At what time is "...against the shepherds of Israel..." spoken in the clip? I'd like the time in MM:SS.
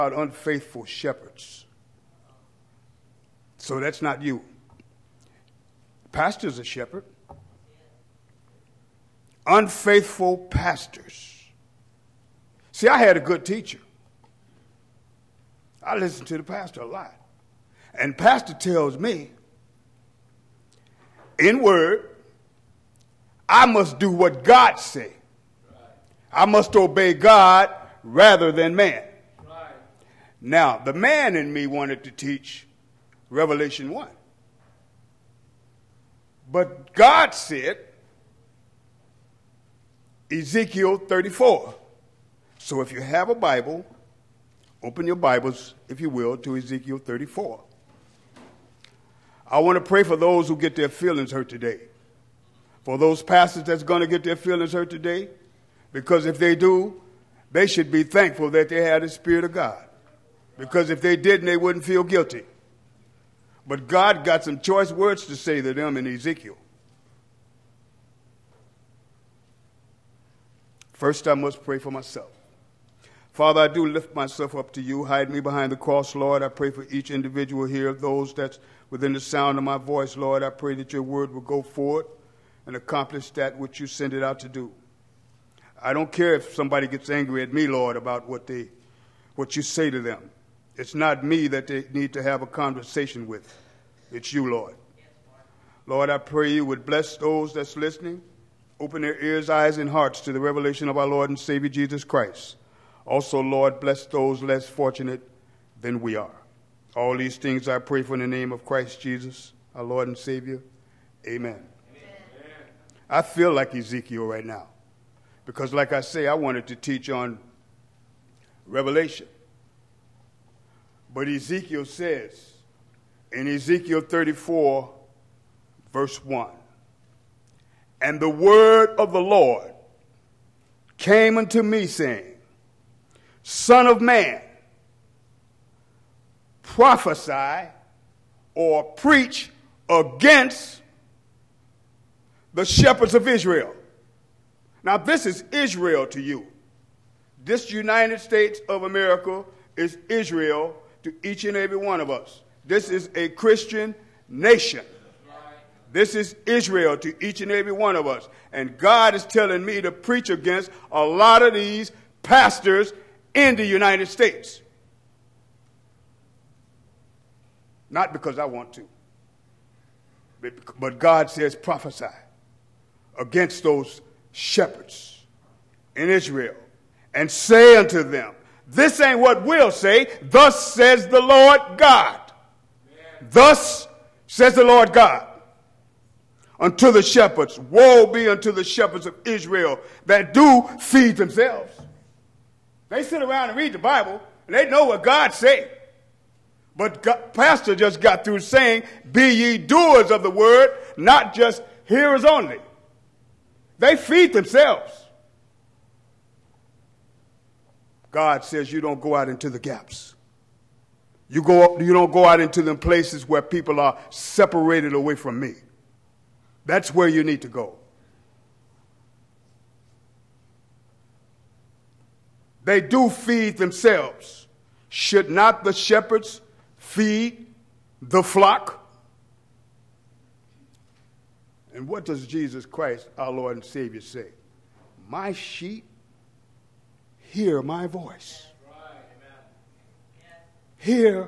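02:19.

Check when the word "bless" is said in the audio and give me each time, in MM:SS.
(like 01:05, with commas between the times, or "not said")
01:36, 01:43.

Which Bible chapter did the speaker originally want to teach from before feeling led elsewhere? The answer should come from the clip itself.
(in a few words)
Revelation 1.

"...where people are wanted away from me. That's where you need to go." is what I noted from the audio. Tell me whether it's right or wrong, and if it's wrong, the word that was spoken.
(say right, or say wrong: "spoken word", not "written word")
wrong: "separated", not "wanted".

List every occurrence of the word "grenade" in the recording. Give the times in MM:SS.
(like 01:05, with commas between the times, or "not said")
not said.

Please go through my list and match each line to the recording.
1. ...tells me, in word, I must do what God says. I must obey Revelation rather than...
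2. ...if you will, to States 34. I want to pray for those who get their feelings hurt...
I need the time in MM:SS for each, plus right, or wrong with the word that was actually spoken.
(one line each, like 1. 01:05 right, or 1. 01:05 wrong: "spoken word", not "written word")
1. 00:18 wrong: "God", not "Revelation"
2. 00:45 wrong: "Ezekiel", not "States".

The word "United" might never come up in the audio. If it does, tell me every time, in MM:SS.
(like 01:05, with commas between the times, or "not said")
02:27, 02:43.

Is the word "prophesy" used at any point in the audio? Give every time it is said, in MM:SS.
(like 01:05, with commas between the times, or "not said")
02:16, 02:51.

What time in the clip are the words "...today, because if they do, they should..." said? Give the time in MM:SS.
00:54.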